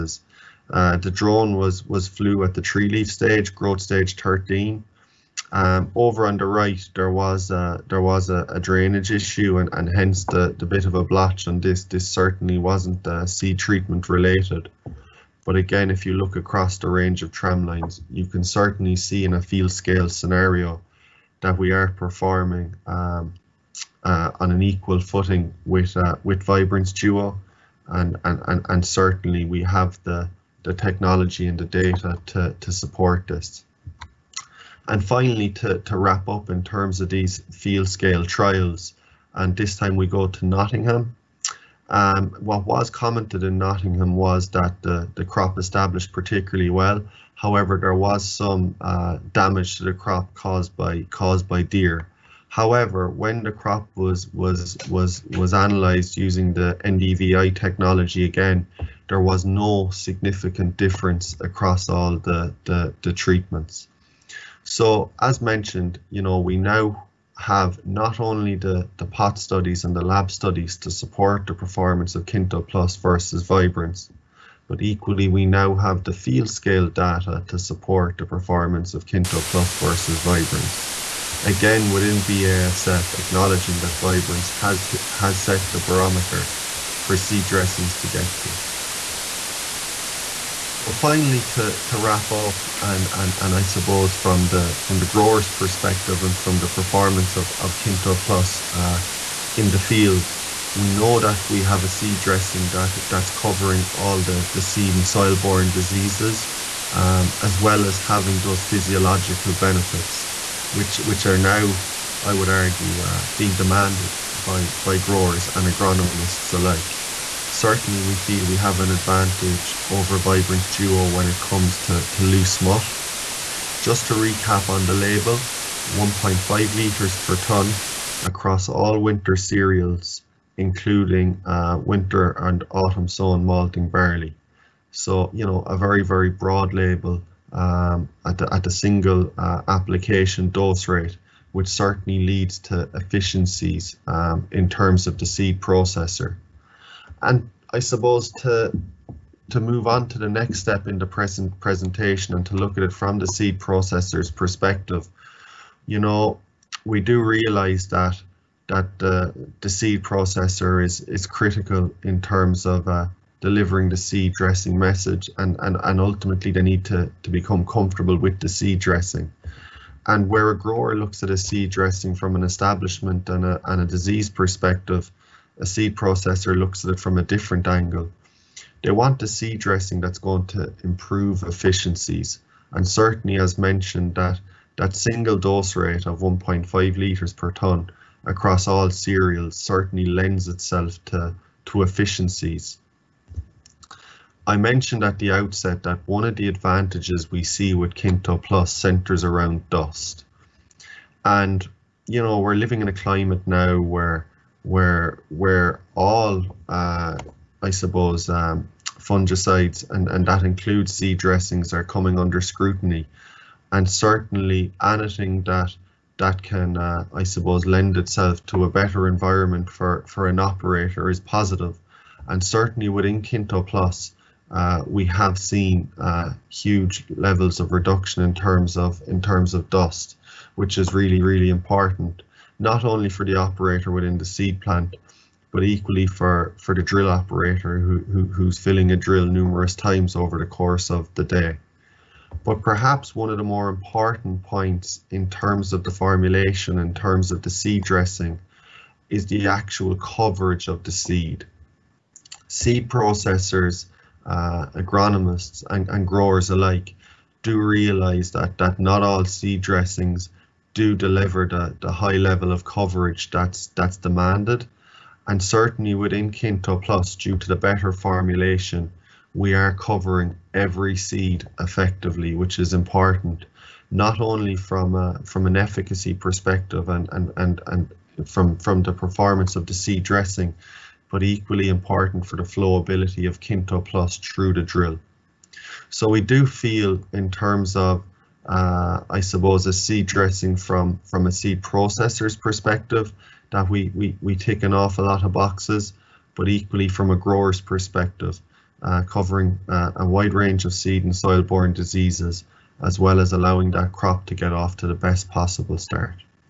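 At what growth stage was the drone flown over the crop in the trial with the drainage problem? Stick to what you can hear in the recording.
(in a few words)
13.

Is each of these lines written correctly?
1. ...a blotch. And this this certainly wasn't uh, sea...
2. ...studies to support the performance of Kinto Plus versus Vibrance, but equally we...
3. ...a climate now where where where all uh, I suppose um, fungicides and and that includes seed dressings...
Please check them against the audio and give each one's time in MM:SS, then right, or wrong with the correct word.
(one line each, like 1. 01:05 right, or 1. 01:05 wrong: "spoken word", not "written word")
1. 00:10 right
2. 01:10 right
3. 03:22 right.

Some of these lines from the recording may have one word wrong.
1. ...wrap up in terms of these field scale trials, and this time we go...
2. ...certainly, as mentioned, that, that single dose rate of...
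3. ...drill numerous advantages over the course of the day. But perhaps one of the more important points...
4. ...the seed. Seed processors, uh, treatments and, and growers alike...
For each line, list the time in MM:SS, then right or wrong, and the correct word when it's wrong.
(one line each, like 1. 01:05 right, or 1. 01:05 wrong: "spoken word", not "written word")
1. 00:35 right
2. 03:02 right
3. 03:58 wrong: "times", not "advantages"
4. 04:10 wrong: "agronomists", not "treatments".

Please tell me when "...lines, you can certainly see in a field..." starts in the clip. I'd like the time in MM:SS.
00:17.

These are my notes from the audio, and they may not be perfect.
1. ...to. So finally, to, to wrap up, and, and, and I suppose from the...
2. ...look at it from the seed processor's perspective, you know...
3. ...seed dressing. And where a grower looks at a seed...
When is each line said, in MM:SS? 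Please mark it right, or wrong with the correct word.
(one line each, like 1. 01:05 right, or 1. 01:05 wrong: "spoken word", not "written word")
1. 01:28 right
2. 02:32 right
3. 02:48 right.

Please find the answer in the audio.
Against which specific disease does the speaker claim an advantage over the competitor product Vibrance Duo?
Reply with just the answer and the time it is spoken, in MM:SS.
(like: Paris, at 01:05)
Loose smut, at 02:02.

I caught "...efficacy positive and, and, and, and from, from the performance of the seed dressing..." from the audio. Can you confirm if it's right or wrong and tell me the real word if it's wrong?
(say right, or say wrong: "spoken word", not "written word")
wrong: "perspective", not "positive".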